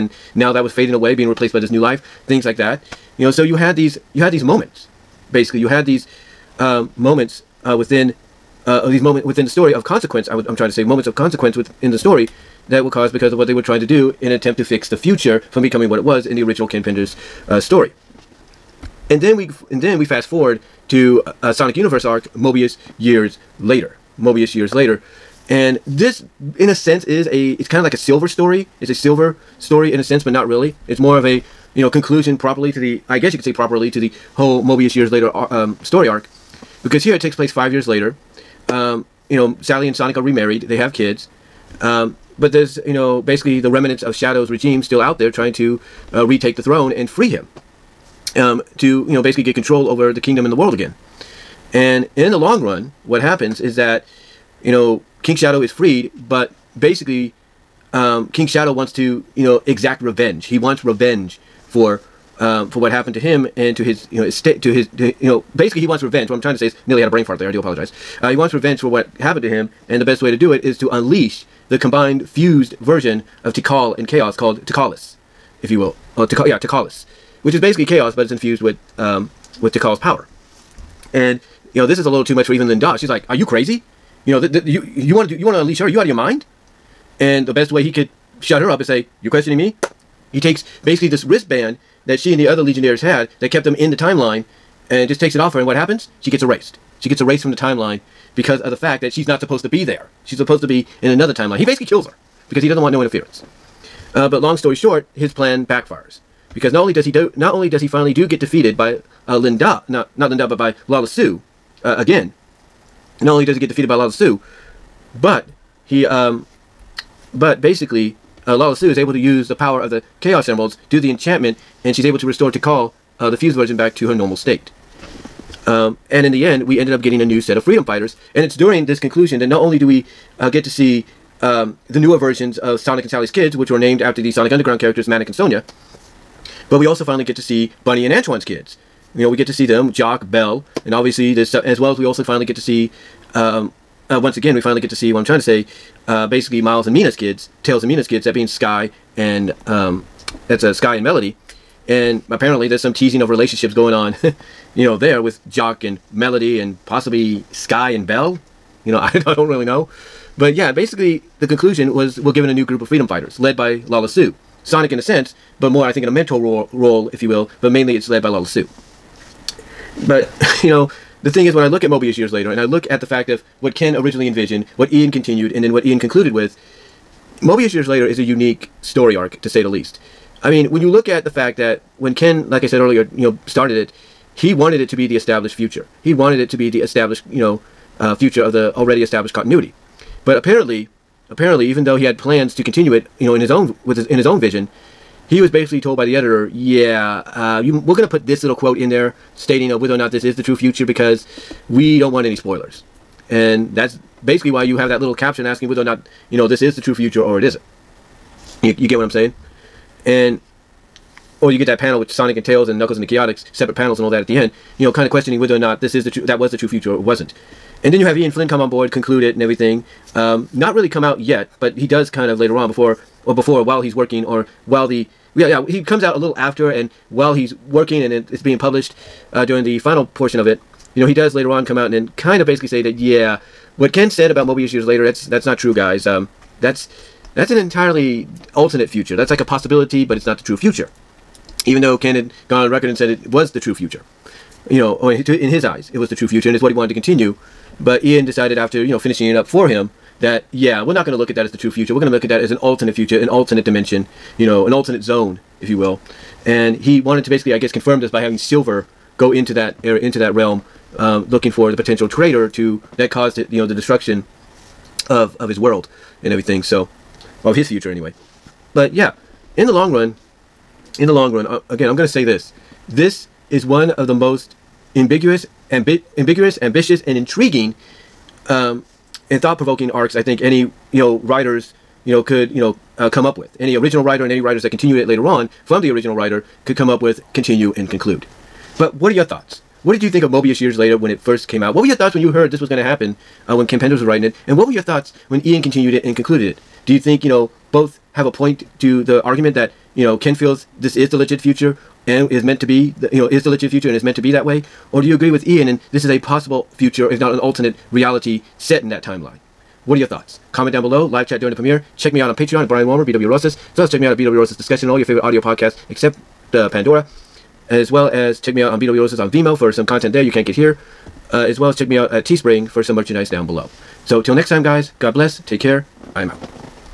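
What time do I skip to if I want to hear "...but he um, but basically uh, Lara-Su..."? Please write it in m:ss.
1:55.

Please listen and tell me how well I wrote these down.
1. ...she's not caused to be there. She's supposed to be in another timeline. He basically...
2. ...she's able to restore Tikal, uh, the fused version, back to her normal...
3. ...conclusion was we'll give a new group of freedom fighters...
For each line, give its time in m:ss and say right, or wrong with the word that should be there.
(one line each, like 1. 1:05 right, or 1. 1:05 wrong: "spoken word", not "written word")
1. 1:39 wrong: "supposed", not "caused"
2. 2:01 right
3. 2:41 right.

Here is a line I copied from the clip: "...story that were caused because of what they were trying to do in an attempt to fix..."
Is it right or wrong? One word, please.
right.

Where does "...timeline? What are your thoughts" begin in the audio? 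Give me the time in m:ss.
5:09.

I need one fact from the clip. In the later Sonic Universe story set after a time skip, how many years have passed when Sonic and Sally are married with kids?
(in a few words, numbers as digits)
5.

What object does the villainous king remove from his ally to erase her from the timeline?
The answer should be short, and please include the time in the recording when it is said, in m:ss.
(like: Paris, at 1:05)
wristband, at 1:31.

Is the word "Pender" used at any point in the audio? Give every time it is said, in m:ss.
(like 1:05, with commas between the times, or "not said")
0:16, 4:53.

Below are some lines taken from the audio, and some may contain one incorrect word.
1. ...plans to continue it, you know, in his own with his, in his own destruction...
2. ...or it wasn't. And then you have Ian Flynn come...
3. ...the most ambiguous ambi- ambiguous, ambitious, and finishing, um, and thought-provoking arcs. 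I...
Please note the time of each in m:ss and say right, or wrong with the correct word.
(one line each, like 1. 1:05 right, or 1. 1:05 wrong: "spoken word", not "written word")
1. 3:12 wrong: "vision", not "destruction"
2. 3:36 right
3. 4:34 wrong: "intriguing", not "finishing".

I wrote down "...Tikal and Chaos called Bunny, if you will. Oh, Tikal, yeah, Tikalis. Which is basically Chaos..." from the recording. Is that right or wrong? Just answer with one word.
wrong.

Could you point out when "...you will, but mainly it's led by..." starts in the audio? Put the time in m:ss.
2:47.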